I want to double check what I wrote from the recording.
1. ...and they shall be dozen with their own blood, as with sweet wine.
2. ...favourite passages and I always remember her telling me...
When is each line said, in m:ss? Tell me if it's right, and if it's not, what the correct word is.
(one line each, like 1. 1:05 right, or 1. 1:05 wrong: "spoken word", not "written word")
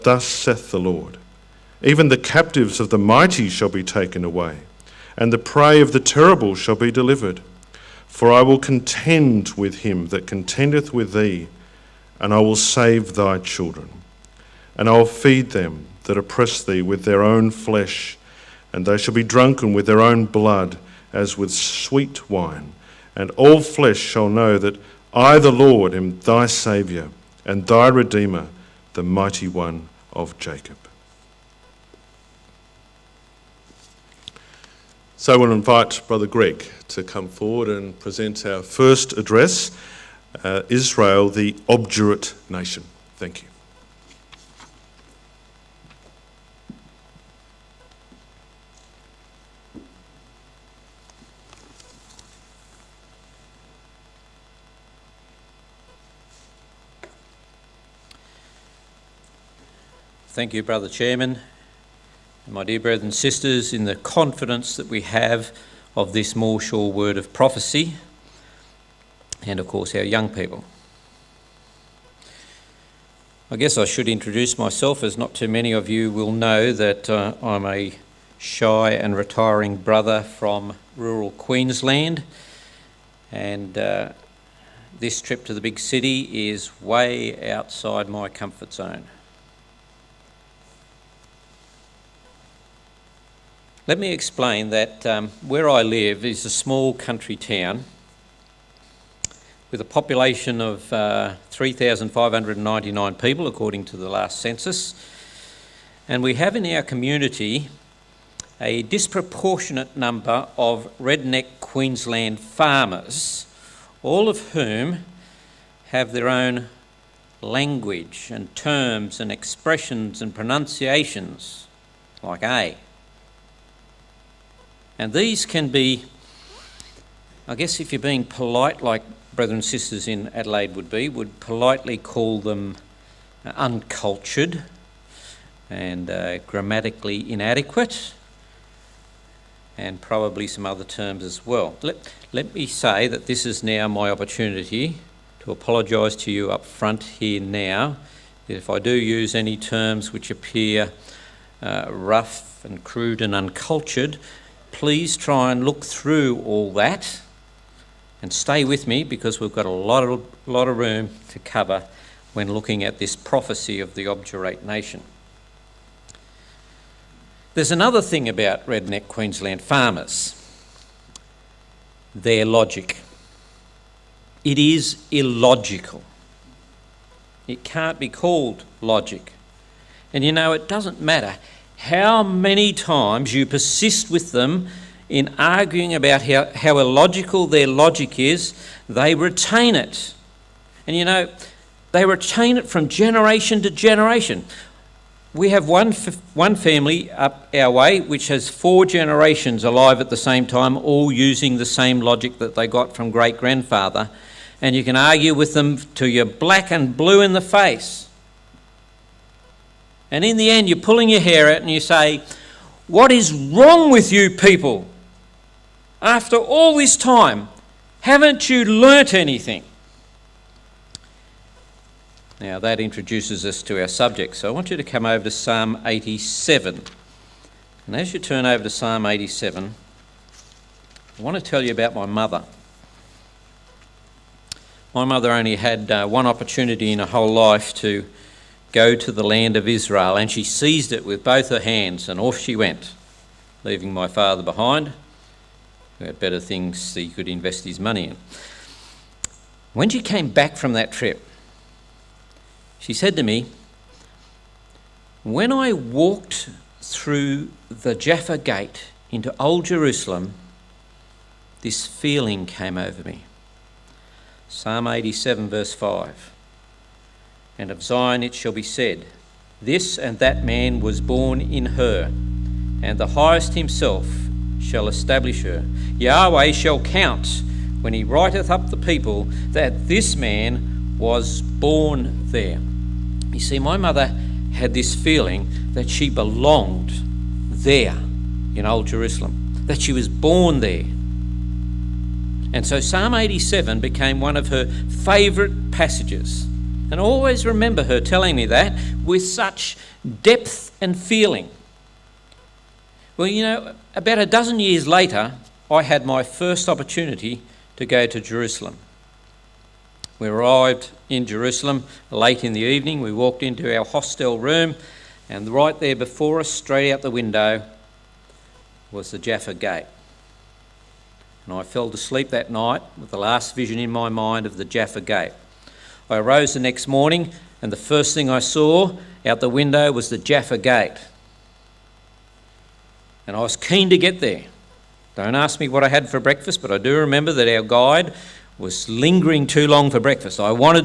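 1. 0:18 wrong: "drunken", not "dozen"
2. 4:54 right.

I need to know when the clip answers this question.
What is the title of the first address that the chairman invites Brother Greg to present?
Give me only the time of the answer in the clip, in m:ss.
0:40.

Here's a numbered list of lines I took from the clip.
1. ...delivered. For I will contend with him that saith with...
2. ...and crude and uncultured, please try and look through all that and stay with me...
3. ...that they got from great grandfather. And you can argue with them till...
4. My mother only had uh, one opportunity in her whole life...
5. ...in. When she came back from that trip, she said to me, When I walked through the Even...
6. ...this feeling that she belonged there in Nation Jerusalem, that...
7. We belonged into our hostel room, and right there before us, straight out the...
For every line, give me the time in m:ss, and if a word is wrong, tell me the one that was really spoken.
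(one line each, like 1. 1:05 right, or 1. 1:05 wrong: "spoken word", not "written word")
1. 0:06 wrong: "contendeth", not "saith"
2. 2:32 right
3. 3:22 right
4. 3:54 right
5. 4:08 wrong: "Jaffa", not "Even"
6. 4:44 wrong: "Old", not "Nation"
7. 5:12 wrong: "walked", not "belonged".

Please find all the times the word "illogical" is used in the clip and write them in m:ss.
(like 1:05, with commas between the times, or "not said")
2:55, 3:06.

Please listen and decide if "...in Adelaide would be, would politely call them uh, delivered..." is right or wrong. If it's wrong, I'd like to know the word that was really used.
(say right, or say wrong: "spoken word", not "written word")
wrong: "uncultured", not "delivered".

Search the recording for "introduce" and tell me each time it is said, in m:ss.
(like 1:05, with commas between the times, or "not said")
1:14, 3:42.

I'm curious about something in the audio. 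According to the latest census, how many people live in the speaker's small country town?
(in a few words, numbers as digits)
3,599.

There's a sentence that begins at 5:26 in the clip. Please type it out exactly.
I rose the next morning, and the first thing I saw out the window was the Jaffa Gate.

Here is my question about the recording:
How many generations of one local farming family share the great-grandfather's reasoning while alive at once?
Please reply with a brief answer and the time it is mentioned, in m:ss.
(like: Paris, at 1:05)
4, at 3:18.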